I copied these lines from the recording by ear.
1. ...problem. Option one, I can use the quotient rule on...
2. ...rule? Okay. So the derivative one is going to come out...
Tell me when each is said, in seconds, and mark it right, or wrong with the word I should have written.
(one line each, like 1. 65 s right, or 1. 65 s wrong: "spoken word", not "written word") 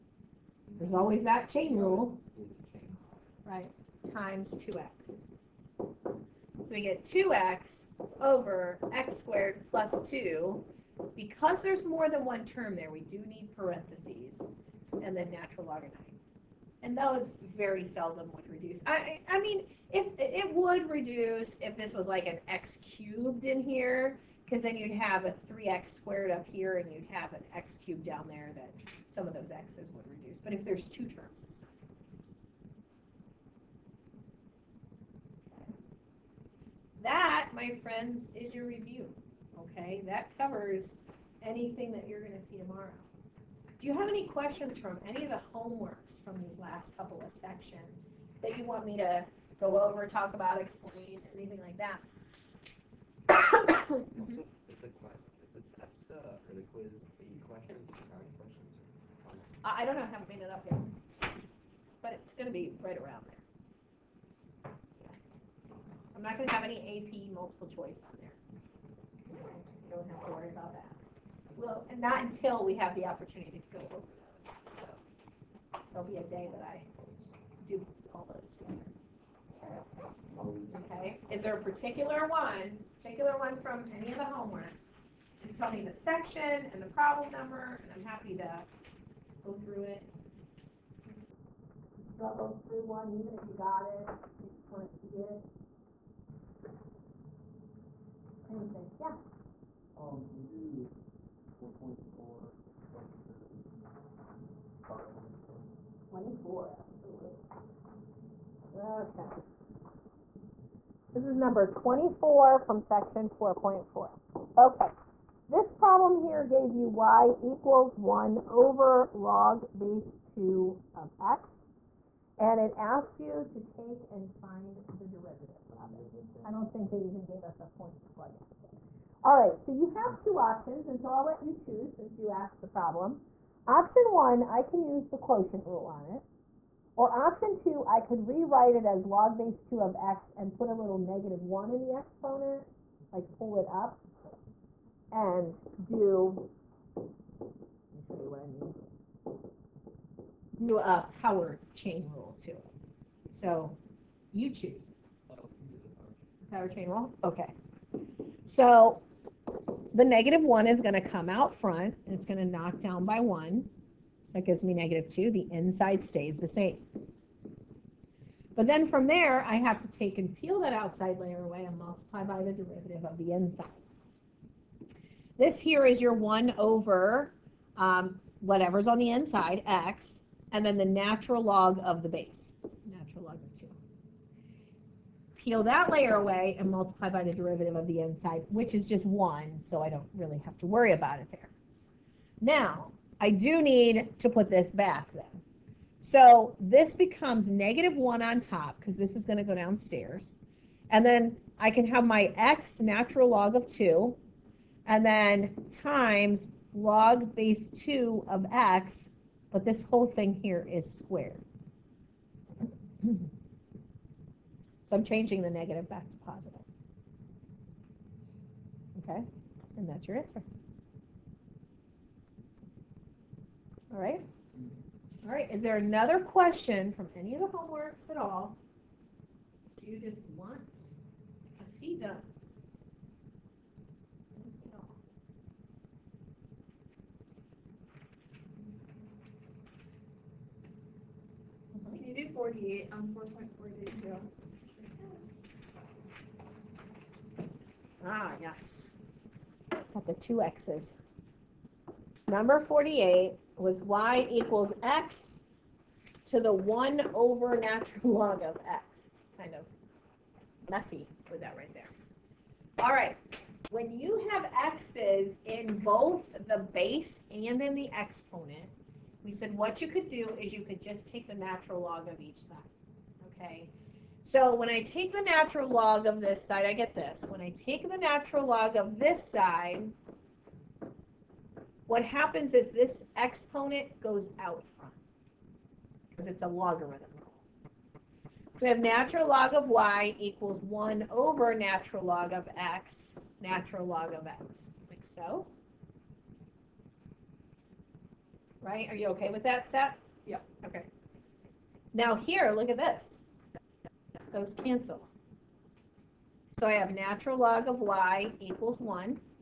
1. 132 s right
2. 156 s wrong: "negative", not "derivative".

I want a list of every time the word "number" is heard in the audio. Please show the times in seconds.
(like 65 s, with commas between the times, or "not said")
87 s, 111 s, 252 s.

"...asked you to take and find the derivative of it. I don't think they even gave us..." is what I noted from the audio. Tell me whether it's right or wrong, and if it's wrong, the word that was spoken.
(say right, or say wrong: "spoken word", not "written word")
right.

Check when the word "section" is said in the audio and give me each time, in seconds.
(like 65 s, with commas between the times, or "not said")
47 s, 85 s, 112 s.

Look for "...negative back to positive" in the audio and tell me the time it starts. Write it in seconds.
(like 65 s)
215 s.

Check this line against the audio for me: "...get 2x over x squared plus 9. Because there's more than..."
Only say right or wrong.
wrong.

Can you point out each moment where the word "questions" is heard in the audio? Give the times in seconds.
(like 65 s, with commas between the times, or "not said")
44 s, 226 s.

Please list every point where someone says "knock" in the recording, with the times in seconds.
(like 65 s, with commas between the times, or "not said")
162 s.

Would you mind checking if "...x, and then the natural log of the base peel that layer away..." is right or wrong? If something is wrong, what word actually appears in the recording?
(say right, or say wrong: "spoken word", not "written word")
right.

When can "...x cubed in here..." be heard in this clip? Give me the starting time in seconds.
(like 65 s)
22 s.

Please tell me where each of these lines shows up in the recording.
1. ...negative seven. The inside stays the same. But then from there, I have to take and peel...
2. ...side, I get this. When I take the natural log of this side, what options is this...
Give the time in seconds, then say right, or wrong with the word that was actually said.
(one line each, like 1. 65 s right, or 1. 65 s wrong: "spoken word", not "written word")
1. 164 s wrong: "two", not "seven"
2. 276 s wrong: "happens", not "options".